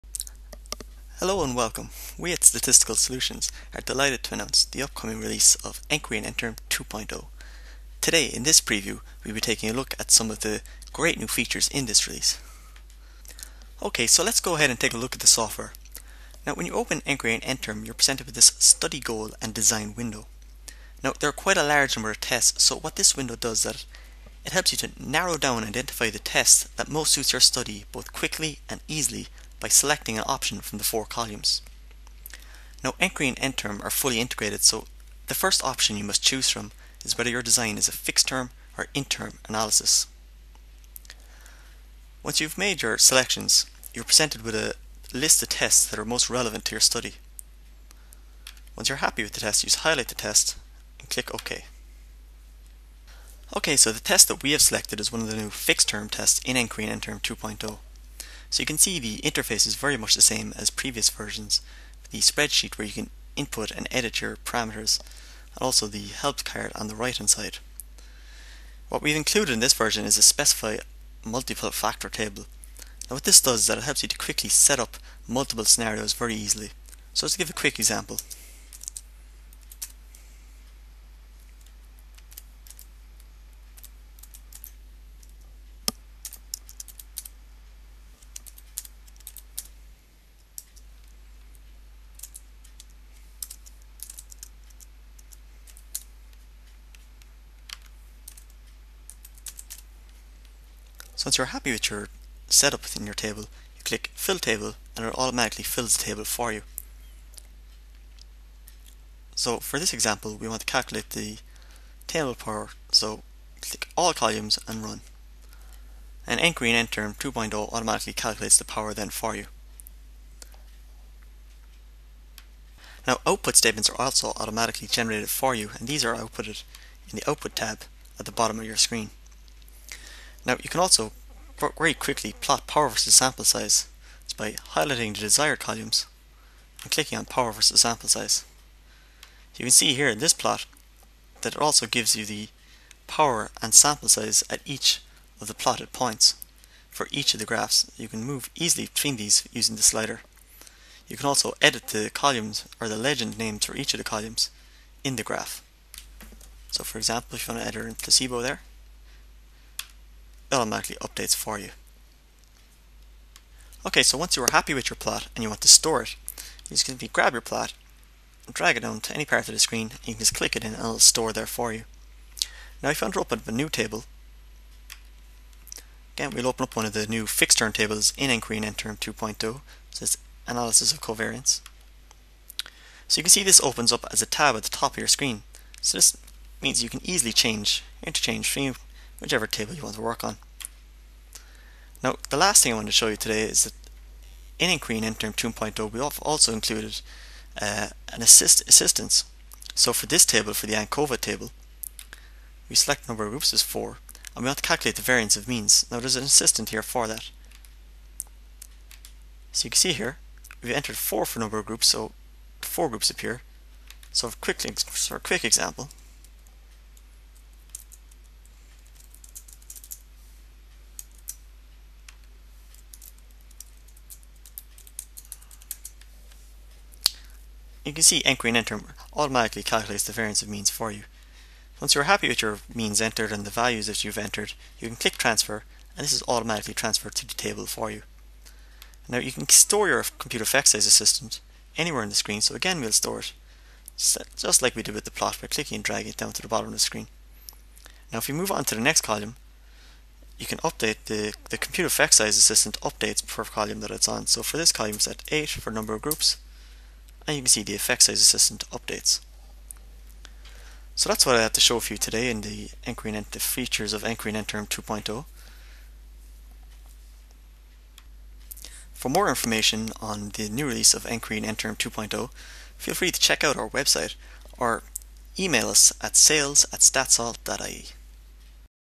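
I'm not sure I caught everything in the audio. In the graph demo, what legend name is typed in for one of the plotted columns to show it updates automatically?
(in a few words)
placebo.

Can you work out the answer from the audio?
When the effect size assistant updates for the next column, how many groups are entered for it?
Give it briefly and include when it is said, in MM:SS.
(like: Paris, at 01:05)
8, at 04:15.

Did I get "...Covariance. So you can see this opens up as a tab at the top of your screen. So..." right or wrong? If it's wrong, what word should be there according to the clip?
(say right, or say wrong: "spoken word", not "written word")
right.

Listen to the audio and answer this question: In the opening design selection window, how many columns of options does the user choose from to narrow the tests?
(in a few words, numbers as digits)
4.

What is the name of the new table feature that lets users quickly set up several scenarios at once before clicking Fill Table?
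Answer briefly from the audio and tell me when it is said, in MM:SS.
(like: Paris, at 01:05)
specify multiple factor table, at 01:10.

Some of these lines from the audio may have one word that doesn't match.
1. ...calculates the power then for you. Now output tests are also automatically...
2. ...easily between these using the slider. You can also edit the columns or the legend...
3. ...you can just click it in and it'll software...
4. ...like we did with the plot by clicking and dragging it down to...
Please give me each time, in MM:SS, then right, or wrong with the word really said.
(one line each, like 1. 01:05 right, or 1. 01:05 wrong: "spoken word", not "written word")
1. 01:58 wrong: "statements", not "tests"
2. 02:28 right
3. 02:50 wrong: "store", not "software"
4. 04:04 right.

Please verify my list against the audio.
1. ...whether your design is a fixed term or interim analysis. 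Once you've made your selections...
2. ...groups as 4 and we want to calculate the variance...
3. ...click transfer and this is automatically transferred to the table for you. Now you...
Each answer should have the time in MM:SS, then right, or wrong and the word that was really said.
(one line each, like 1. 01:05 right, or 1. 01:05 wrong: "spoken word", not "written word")
1. 00:37 right
2. 03:23 right
3. 03:54 right.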